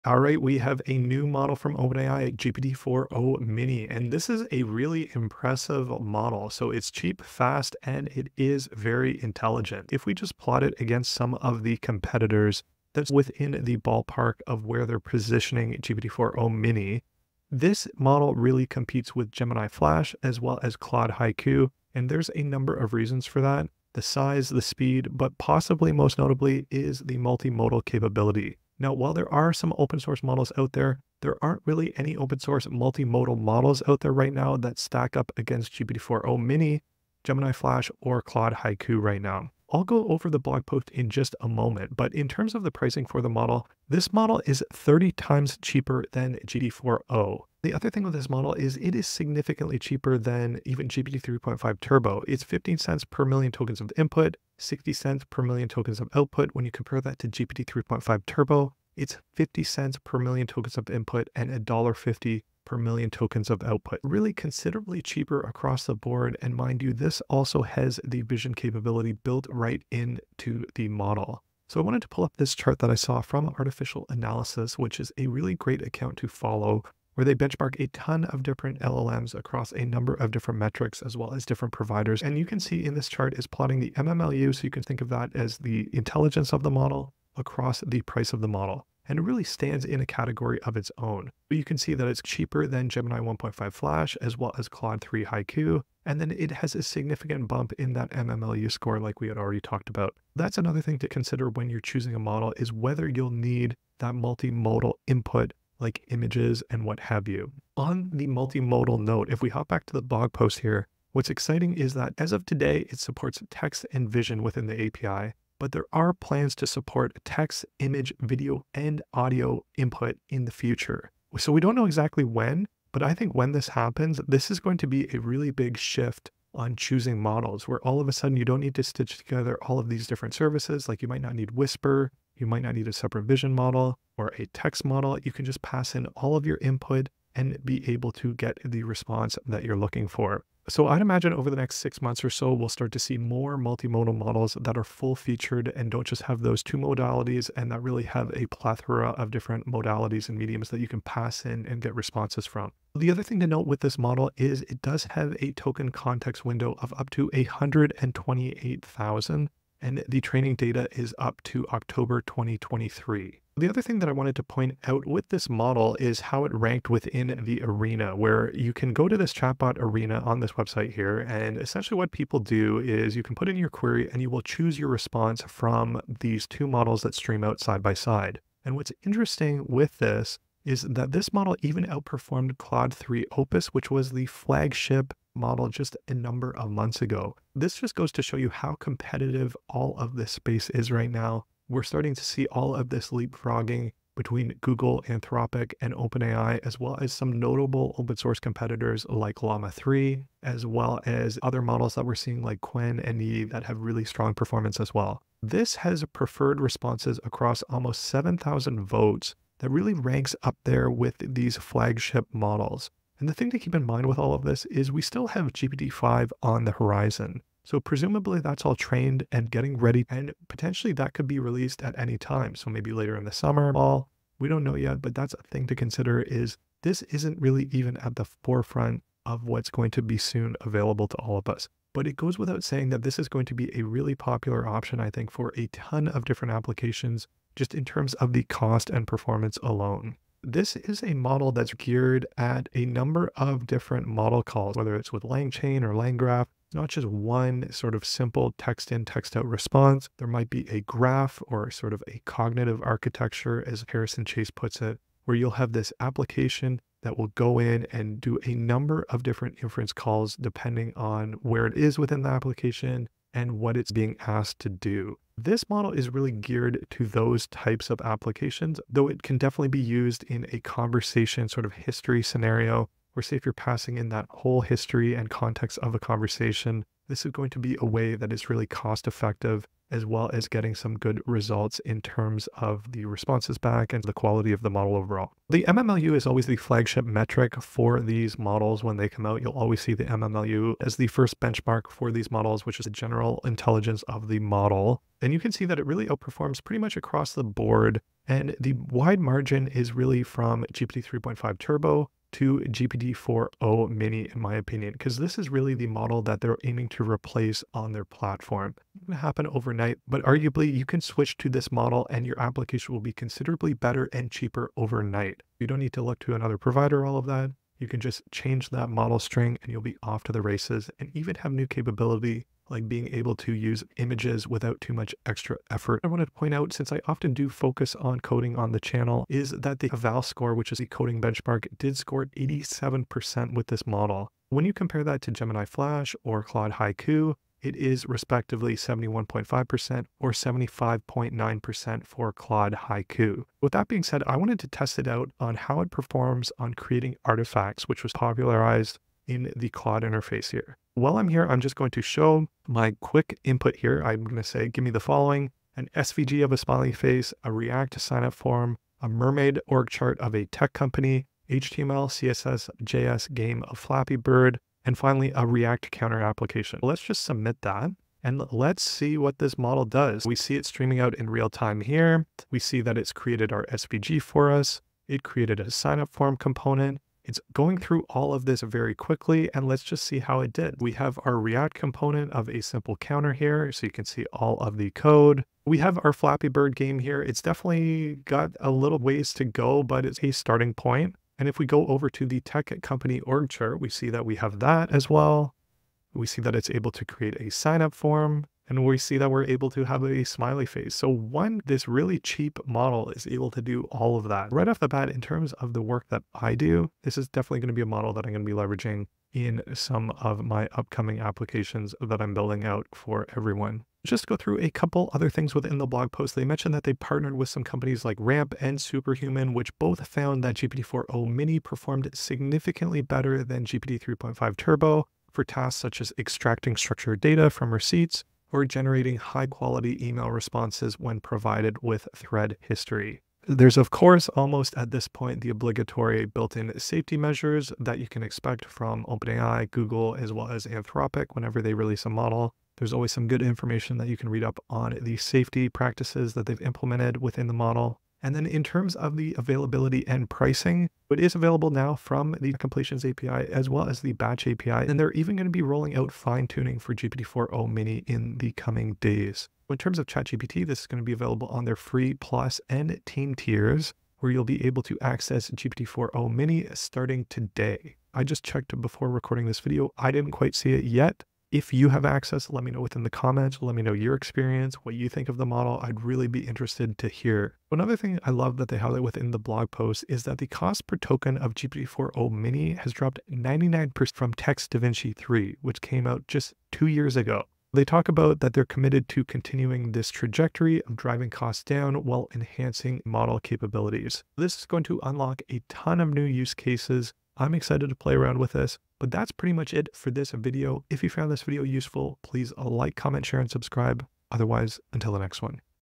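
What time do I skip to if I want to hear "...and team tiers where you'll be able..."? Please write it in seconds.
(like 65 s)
462 s.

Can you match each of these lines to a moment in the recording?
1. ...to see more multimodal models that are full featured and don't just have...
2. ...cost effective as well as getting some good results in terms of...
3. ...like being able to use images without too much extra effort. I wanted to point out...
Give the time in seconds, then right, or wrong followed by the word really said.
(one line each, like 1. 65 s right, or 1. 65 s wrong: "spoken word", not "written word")
1. 142 s right
2. 278 s right
3. 322 s right.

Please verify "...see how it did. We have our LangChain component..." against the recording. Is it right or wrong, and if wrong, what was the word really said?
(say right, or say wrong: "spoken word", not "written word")
wrong: "React", not "LangChain".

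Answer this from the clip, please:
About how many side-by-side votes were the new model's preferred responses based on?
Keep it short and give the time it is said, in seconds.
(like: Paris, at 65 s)
Almost 7,000, at 207 s.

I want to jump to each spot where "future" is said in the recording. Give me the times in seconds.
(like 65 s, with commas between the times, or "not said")
120 s.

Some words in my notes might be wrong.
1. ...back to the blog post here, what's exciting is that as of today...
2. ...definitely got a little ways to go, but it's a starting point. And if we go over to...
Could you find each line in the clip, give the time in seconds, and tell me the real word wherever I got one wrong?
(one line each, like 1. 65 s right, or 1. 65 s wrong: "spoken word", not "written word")
1. 109 s right
2. 387 s right.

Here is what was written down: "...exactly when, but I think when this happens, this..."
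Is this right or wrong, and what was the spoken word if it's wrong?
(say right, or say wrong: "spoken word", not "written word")
right.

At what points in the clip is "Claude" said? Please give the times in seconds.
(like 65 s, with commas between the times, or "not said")
20 s, 38 s, 94 s, 182 s, 336 s, 342 s, 349 s.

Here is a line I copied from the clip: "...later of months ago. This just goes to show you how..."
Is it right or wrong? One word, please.
wrong.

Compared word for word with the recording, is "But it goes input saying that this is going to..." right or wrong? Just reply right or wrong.
wrong.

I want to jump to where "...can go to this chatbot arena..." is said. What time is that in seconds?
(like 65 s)
168 s.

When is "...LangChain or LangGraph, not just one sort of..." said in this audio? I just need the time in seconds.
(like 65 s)
245 s.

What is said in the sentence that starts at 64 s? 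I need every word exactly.
Really considerably cheaper across the board.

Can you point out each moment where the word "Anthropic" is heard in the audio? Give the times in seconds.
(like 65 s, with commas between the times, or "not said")
195 s, 440 s.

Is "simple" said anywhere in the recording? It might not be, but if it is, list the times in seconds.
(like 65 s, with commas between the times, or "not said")
248 s, 382 s.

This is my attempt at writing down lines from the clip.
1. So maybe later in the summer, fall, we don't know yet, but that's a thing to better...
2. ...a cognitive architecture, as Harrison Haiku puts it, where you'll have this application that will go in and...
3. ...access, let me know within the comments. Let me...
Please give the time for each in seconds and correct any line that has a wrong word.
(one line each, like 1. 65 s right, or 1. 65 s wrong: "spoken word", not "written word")
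1. 222 s wrong: "consider", not "better"
2. 252 s wrong: "Chase", not "Haiku"
3. 472 s right.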